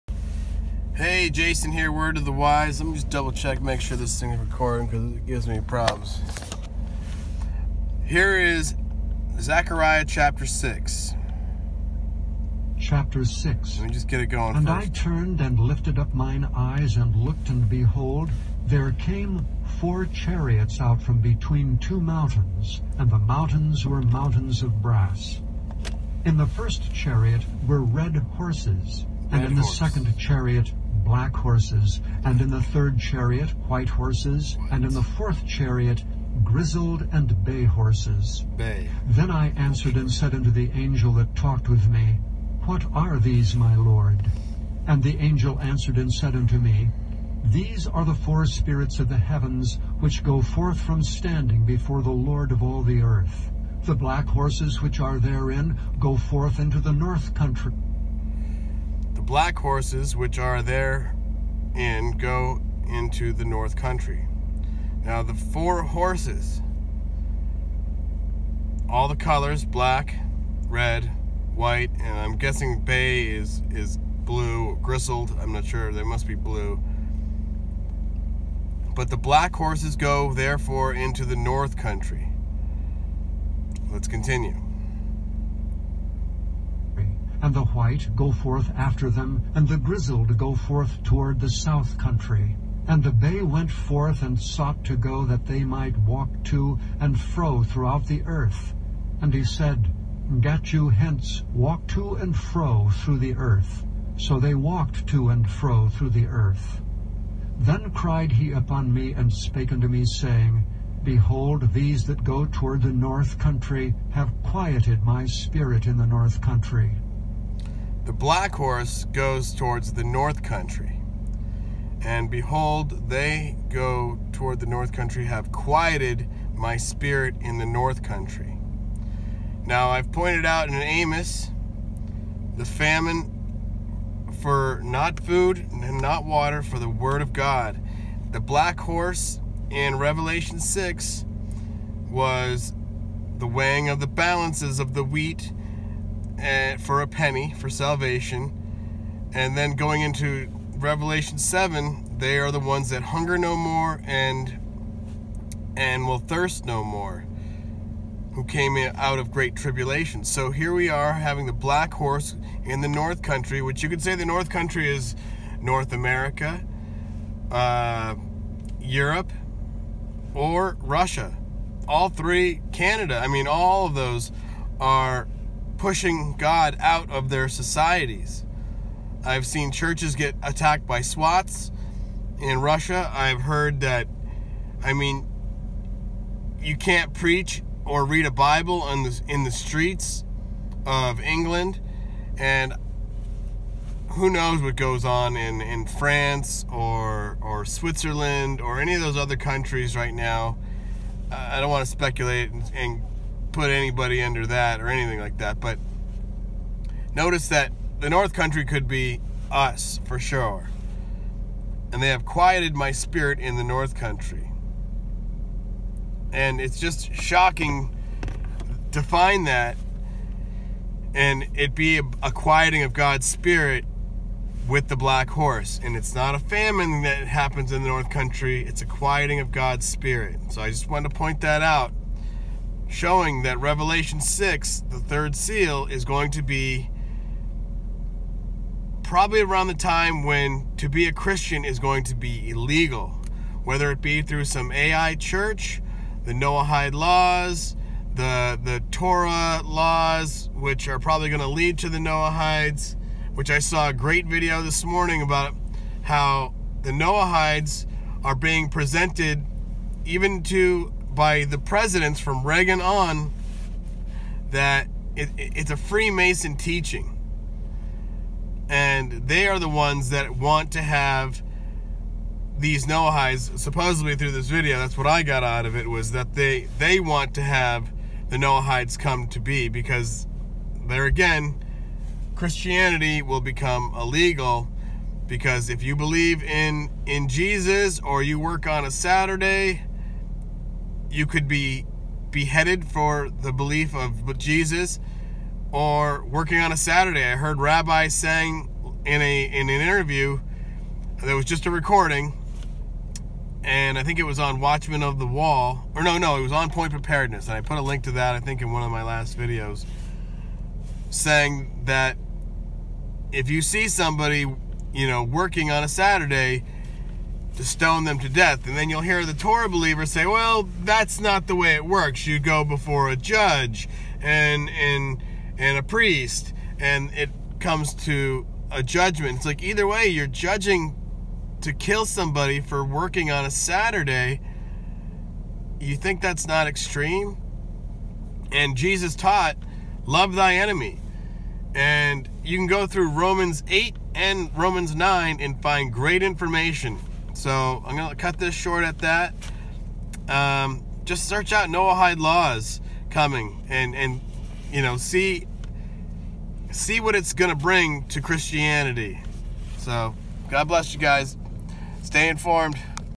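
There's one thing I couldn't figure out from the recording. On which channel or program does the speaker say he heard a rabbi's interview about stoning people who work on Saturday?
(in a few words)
Point Preparedness.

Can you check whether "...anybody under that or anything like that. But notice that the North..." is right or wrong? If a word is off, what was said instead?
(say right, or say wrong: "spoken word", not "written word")
right.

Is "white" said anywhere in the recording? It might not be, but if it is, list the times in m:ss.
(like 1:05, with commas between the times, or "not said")
0:33, 1:11, 1:27.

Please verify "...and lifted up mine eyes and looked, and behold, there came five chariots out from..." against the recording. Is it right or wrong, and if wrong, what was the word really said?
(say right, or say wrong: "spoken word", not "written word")
wrong: "four", not "five".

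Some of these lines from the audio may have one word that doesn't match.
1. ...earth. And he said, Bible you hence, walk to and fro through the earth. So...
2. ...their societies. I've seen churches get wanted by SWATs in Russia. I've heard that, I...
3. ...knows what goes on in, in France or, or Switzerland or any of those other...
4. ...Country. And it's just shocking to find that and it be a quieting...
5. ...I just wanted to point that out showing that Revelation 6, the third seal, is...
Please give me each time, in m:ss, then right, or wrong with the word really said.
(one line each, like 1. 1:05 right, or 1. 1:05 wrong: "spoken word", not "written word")
1. 1:38 wrong: "Get", not "Bible"
2. 2:57 wrong: "attacked", not "wanted"
3. 3:14 right
4. 3:33 right
5. 3:50 right.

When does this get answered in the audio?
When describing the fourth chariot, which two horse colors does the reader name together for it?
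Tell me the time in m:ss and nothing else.
0:36.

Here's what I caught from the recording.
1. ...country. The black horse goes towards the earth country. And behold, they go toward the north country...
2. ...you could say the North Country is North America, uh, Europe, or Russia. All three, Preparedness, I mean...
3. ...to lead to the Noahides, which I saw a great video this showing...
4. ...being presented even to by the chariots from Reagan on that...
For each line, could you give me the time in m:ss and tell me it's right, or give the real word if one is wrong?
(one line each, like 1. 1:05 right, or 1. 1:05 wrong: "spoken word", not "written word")
1. 1:56 wrong: "north", not "earth"
2. 2:43 wrong: "Canada", not "Preparedness"
3. 4:11 wrong: "morning", not "showing"
4. 4:18 wrong: "presidents", not "chariots".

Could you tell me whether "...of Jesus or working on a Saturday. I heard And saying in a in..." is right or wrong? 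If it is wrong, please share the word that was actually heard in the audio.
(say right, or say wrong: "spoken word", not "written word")
wrong: "Rabbi", not "And".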